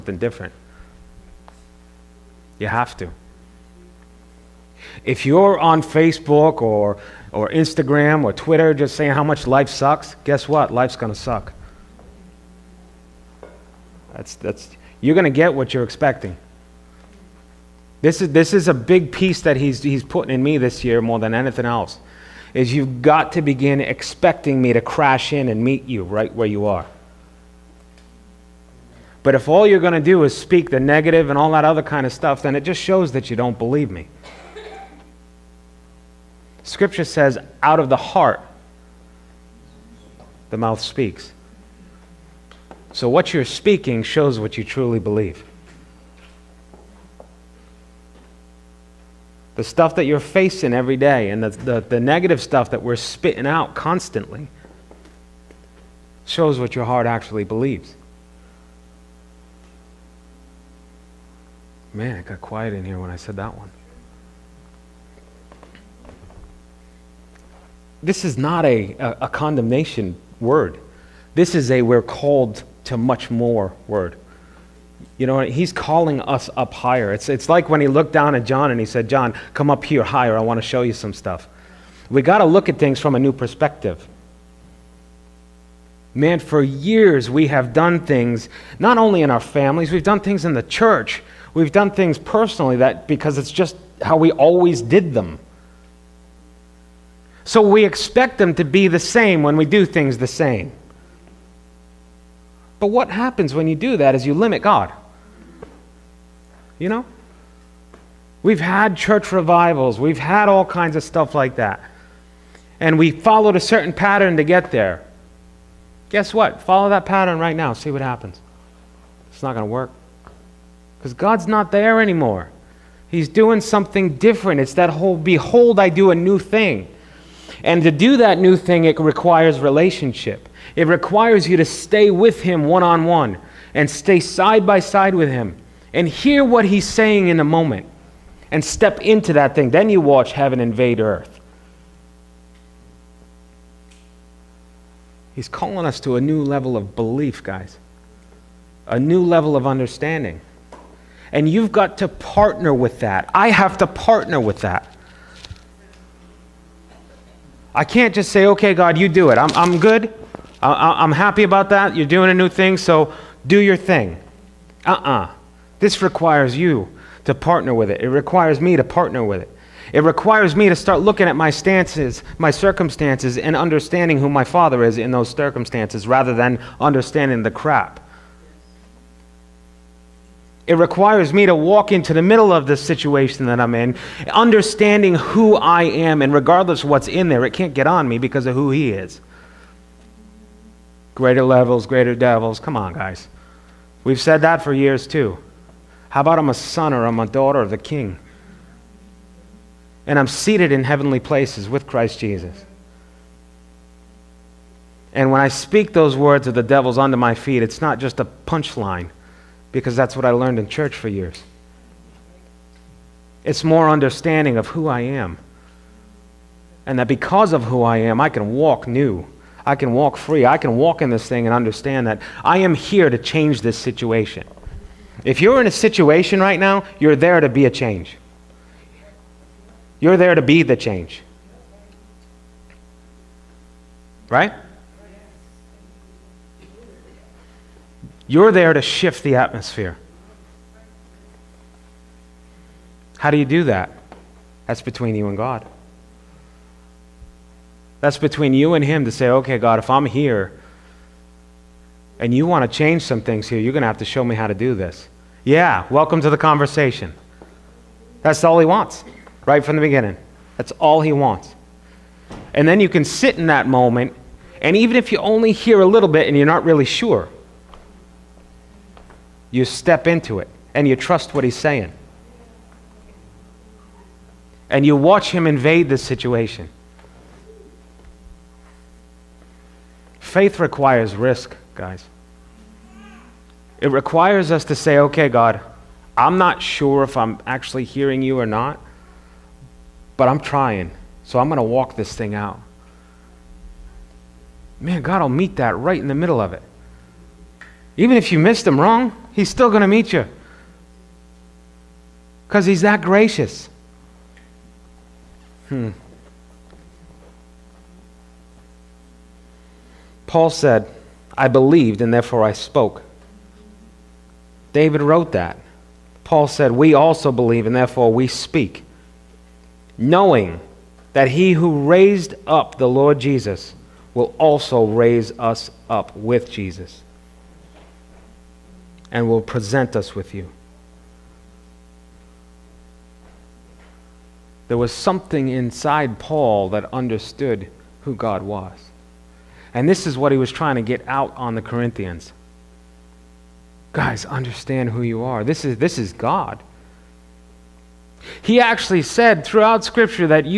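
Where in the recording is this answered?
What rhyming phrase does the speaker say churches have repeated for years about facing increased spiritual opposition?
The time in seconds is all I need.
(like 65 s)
191 s.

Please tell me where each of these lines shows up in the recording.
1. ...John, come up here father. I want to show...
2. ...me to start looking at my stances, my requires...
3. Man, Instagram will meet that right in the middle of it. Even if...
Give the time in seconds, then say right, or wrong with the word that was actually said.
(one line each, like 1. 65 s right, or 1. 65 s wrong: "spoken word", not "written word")
1. 79 s wrong: "higher", not "father"
2. 170 s wrong: "circumstances", not "requires"
3. 294 s wrong: "God", not "Instagram".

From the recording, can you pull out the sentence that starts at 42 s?
So what you're speaking shows what you truly believe.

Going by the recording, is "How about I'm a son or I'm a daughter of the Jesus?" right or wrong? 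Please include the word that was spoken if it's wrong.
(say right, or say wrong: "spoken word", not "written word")
wrong: "King", not "Jesus".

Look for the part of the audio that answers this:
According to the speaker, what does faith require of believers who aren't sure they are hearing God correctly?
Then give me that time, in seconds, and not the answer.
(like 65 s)
281 s.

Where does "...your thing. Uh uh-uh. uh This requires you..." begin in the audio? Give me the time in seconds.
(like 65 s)
163 s.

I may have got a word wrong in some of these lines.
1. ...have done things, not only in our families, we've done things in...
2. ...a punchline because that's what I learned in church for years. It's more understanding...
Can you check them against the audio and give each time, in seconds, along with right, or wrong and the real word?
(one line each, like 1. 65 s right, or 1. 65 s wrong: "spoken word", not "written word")
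1. 87 s right
2. 208 s right.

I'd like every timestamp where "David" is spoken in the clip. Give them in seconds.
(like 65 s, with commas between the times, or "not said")
314 s.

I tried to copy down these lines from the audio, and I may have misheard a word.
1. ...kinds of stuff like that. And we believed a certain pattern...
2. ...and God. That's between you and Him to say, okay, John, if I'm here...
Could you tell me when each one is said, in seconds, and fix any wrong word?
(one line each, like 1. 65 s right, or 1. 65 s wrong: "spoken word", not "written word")
1. 110 s wrong: "followed", not "believed"
2. 245 s wrong: "God", not "John".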